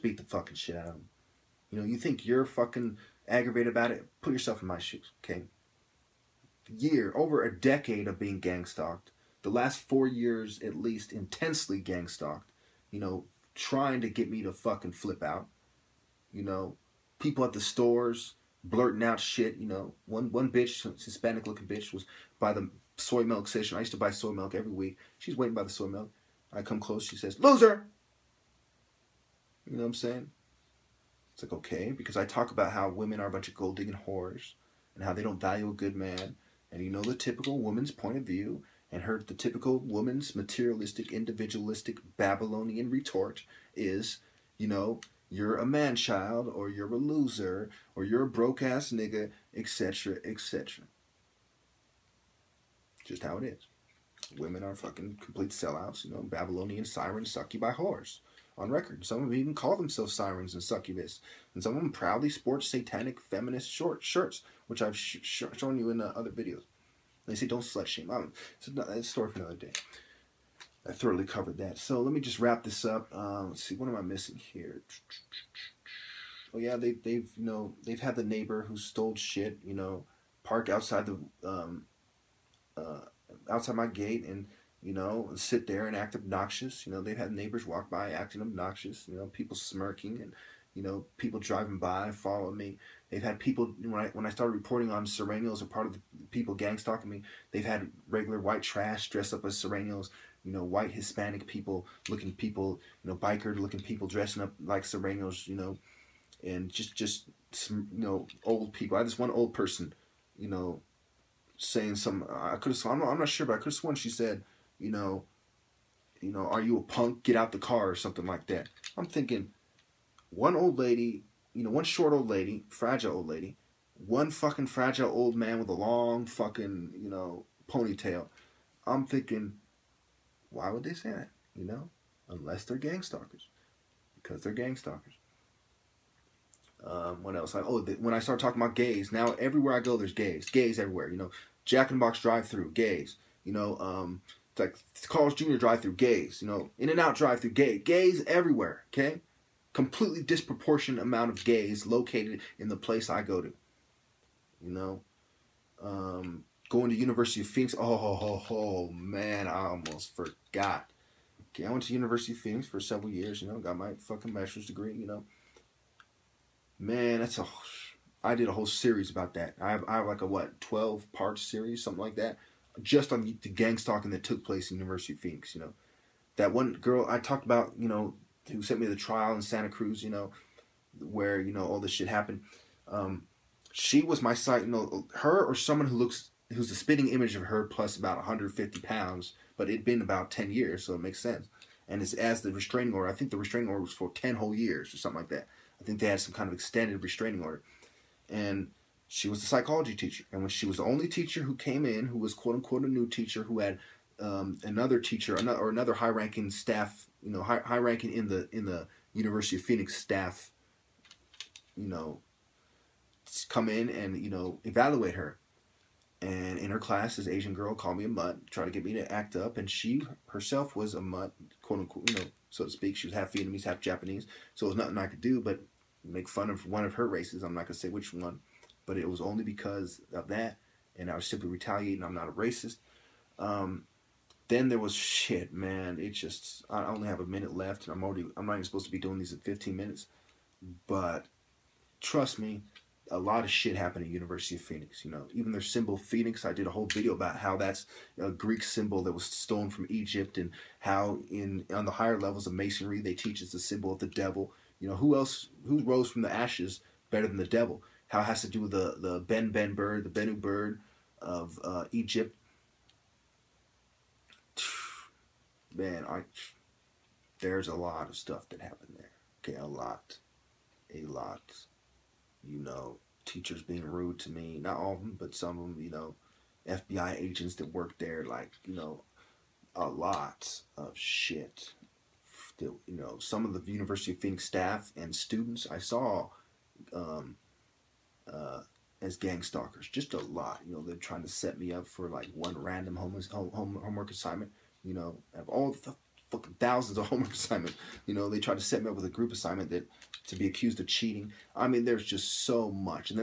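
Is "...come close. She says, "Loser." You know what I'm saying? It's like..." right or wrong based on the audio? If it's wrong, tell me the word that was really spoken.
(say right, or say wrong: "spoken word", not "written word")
right.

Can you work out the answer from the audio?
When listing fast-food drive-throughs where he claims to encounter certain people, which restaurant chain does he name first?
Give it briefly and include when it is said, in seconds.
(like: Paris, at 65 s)
Jack in the Box, at 141 s.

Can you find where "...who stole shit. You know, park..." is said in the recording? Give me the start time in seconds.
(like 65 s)
78 s.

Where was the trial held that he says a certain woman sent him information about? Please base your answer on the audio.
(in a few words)
Santa Cruz.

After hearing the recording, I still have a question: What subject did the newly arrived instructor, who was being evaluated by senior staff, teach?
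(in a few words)
Psychology.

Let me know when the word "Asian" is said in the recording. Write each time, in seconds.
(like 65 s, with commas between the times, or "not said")
217 s.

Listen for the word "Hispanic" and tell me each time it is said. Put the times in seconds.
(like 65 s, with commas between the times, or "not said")
21 s, 100 s.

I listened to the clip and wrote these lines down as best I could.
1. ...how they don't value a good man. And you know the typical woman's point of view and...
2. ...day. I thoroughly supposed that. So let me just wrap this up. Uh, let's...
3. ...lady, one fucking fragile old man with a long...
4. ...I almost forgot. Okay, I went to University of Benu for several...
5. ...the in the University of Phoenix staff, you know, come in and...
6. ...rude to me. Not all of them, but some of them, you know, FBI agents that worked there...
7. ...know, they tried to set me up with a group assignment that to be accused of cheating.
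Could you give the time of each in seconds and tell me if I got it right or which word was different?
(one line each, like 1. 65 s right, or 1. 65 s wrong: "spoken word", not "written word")
1. 35 s right
2. 69 s wrong: "covered", not "supposed"
3. 123 s right
4. 159 s wrong: "Phoenix", not "Benu"
5. 208 s right
6. 273 s right
7. 298 s right.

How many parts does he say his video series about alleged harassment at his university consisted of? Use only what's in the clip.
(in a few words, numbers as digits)
12.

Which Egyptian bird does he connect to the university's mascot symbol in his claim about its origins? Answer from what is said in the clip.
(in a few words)
Benu bird.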